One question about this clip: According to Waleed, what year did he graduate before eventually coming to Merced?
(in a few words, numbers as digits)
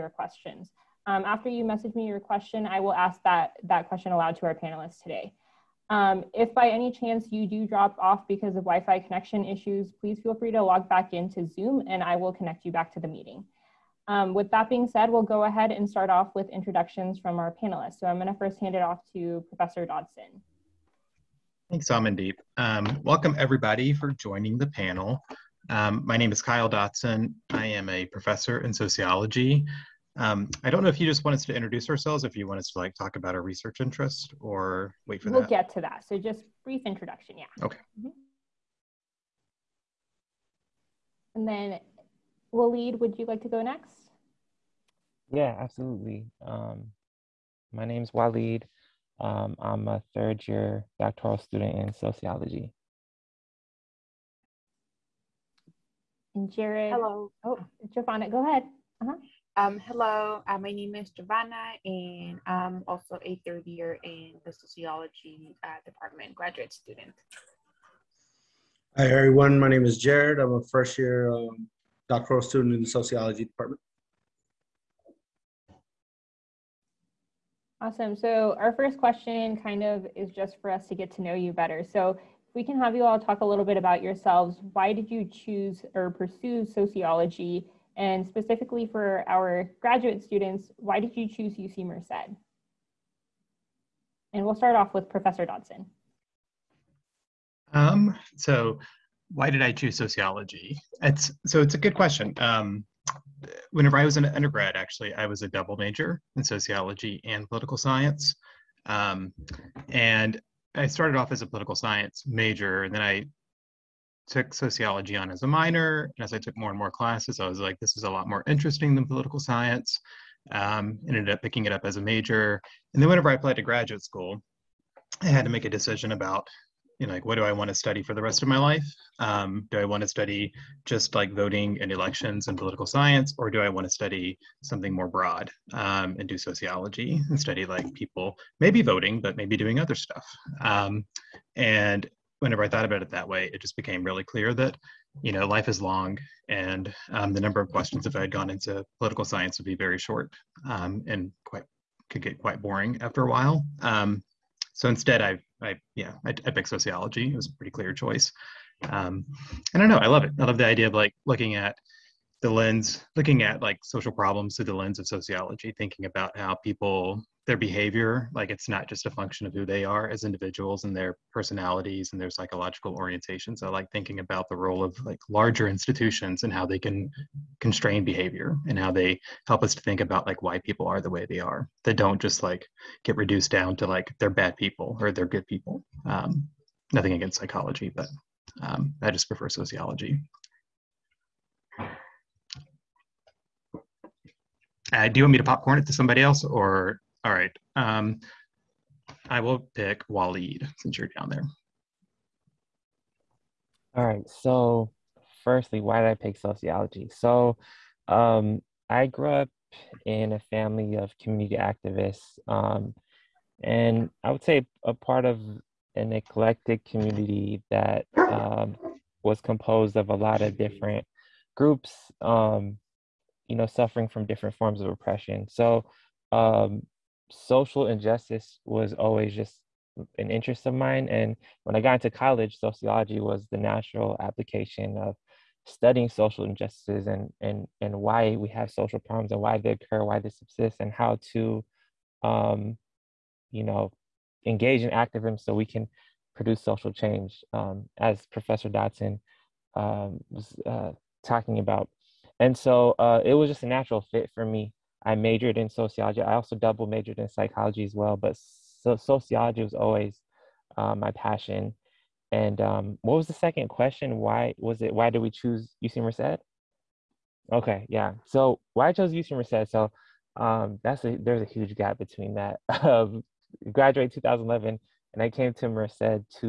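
2011.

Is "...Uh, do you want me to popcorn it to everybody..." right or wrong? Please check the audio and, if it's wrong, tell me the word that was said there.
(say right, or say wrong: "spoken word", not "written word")
wrong: "somebody", not "everybody".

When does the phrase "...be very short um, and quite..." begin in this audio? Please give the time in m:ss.
2:29.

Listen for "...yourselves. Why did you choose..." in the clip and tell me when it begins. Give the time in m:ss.
1:24.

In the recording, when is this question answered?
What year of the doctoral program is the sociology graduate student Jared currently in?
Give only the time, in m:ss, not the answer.
1:10.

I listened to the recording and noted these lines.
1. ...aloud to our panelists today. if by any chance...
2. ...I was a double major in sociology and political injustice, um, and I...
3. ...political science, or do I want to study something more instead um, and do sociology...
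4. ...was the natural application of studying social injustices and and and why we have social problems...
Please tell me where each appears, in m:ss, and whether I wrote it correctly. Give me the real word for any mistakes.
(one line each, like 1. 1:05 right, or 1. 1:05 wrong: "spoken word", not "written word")
1. 0:04 right
2. 1:45 wrong: "science", not "injustice"
3. 2:12 wrong: "broad", not "instead"
4. 3:53 right.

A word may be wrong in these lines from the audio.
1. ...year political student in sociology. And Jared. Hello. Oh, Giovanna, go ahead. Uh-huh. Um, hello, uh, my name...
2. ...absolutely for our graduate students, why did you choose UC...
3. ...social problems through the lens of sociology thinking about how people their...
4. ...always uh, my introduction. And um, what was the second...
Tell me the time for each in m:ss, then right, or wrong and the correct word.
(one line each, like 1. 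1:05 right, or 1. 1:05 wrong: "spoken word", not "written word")
1. 0:50 wrong: "doctoral", not "political"
2. 1:28 wrong: "specifically", not "absolutely"
3. 2:43 right
4. 4:19 wrong: "passion", not "introduction".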